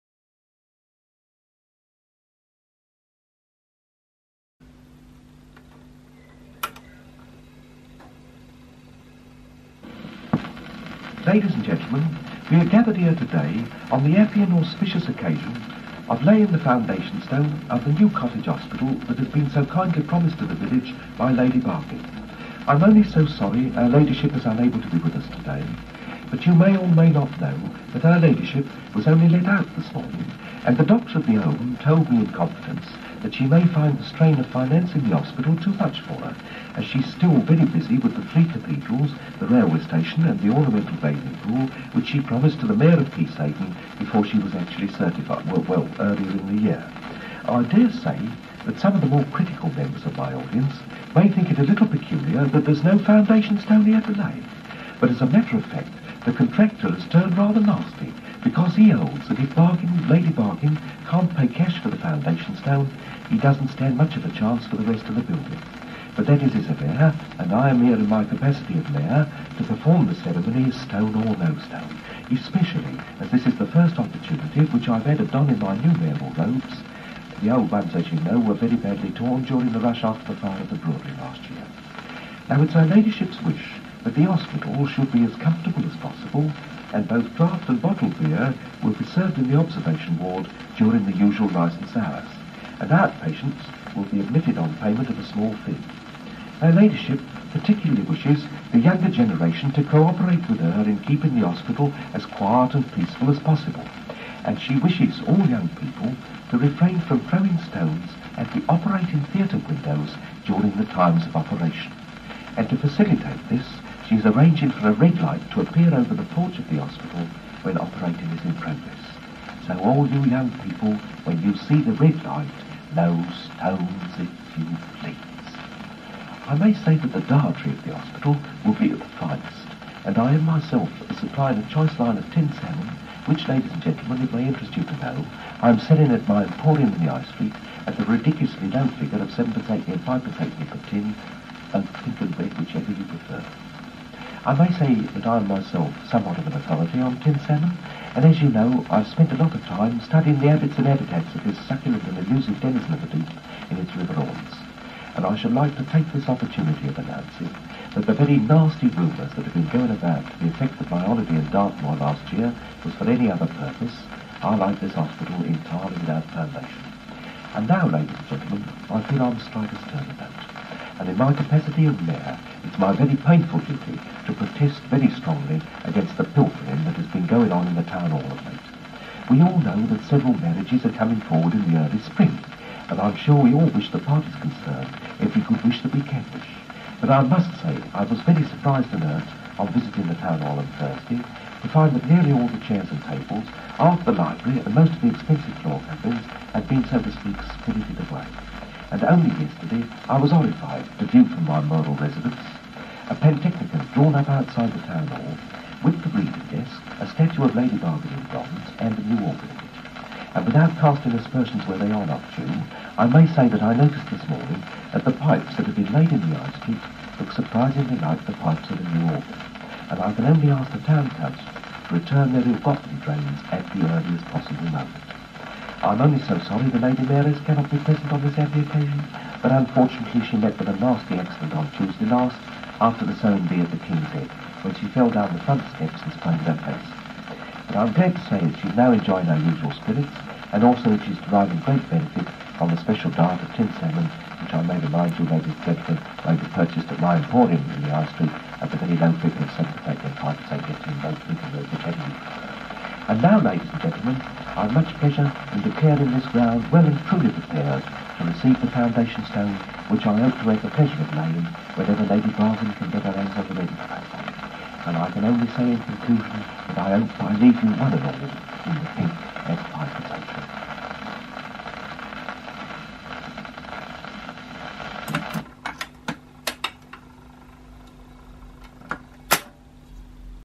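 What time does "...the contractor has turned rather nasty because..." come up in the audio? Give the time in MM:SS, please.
00:56.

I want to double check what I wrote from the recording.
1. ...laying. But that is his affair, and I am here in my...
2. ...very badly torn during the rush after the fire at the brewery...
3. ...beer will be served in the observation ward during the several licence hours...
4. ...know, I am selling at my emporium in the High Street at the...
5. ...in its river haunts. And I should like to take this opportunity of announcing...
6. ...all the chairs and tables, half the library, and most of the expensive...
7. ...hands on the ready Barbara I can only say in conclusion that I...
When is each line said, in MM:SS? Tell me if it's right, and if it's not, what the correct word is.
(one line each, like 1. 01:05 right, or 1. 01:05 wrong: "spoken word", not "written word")
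1. 01:05 wrong: "building", not "laying"
2. 01:18 right
3. 01:28 wrong: "usual", not "several"
4. 02:14 right
5. 02:33 right
6. 03:12 right
7. 04:23 wrong: "And", not "Barbara".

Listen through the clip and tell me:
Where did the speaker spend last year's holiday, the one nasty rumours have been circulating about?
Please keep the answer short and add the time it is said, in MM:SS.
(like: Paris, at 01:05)
Dartmoor, at 02:41.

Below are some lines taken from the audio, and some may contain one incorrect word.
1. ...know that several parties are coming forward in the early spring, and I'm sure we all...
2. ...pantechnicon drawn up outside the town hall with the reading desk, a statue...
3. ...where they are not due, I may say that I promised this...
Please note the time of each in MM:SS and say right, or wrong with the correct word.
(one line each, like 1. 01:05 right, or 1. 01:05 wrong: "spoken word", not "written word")
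1. 02:59 wrong: "marriages", not "parties"
2. 03:23 right
3. 03:31 wrong: "noticed", not "promised".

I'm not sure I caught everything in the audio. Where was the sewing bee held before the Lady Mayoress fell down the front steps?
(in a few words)
the King's Head.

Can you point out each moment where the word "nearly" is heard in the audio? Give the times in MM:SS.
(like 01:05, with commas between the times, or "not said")
03:12.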